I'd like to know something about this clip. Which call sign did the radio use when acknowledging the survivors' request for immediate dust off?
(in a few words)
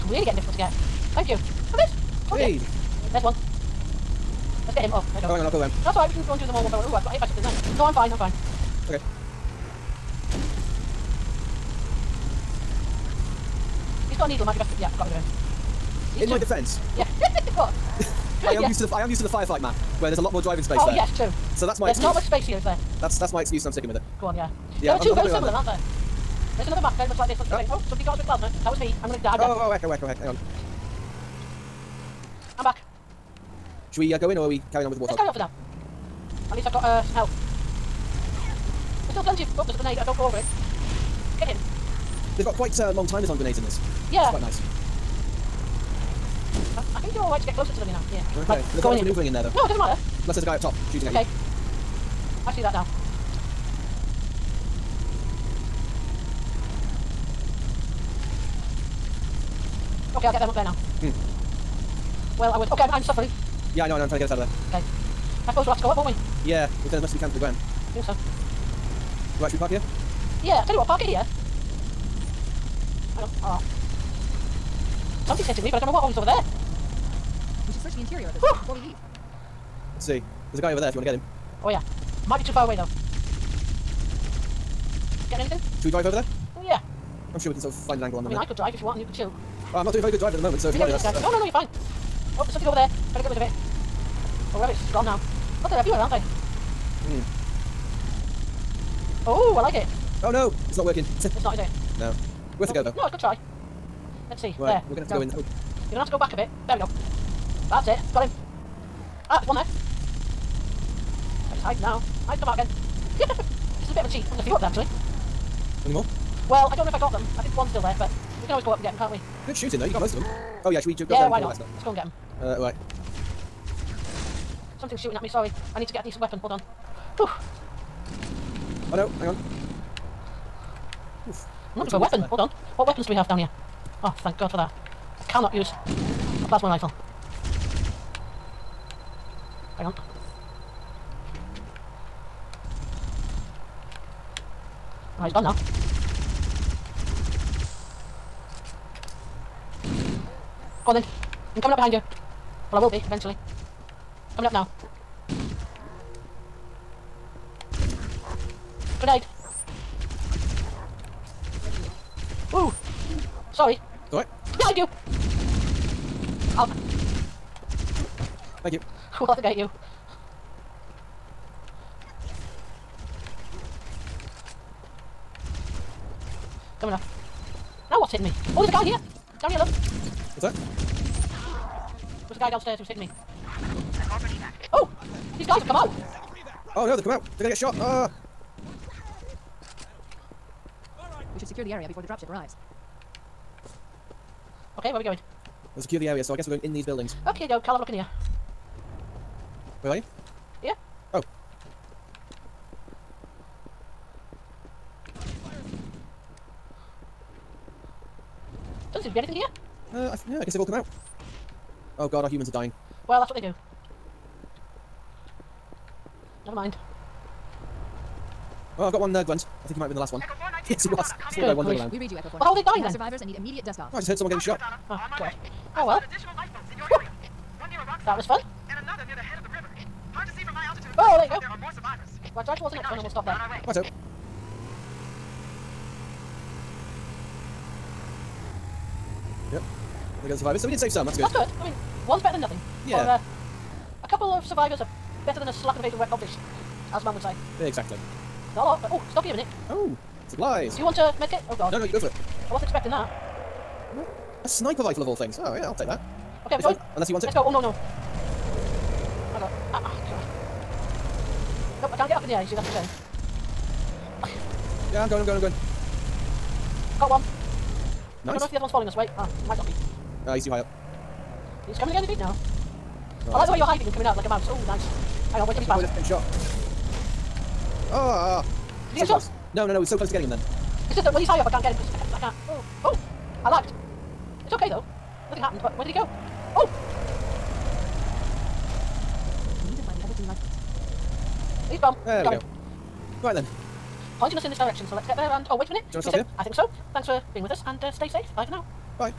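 Echo Four.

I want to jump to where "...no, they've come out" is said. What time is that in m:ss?
3:06.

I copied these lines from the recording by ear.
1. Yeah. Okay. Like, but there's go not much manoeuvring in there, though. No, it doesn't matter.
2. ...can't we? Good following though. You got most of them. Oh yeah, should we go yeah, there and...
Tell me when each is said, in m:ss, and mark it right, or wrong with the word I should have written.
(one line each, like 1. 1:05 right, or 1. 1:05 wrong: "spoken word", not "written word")
1. 0:48 right
2. 1:58 wrong: "shooting", not "following".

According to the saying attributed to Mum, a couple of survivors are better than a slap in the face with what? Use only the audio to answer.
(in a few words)
Wet codfish.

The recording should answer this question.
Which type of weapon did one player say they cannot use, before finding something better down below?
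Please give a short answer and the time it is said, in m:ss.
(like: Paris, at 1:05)
Plasma rifle, at 2:16.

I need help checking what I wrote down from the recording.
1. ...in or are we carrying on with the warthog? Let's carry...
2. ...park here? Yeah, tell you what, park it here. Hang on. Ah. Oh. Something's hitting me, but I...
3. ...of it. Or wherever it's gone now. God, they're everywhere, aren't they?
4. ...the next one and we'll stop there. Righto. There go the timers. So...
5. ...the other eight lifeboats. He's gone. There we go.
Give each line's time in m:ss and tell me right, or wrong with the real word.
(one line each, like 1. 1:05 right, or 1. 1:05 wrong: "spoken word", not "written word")
1. 0:34 right
2. 1:09 right
3. 1:33 right
4. 3:52 wrong: "survivors", not "timers"
5. 4:49 wrong: "two", not "eight".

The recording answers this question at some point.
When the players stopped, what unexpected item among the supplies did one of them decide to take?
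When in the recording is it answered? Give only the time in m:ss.
4:14.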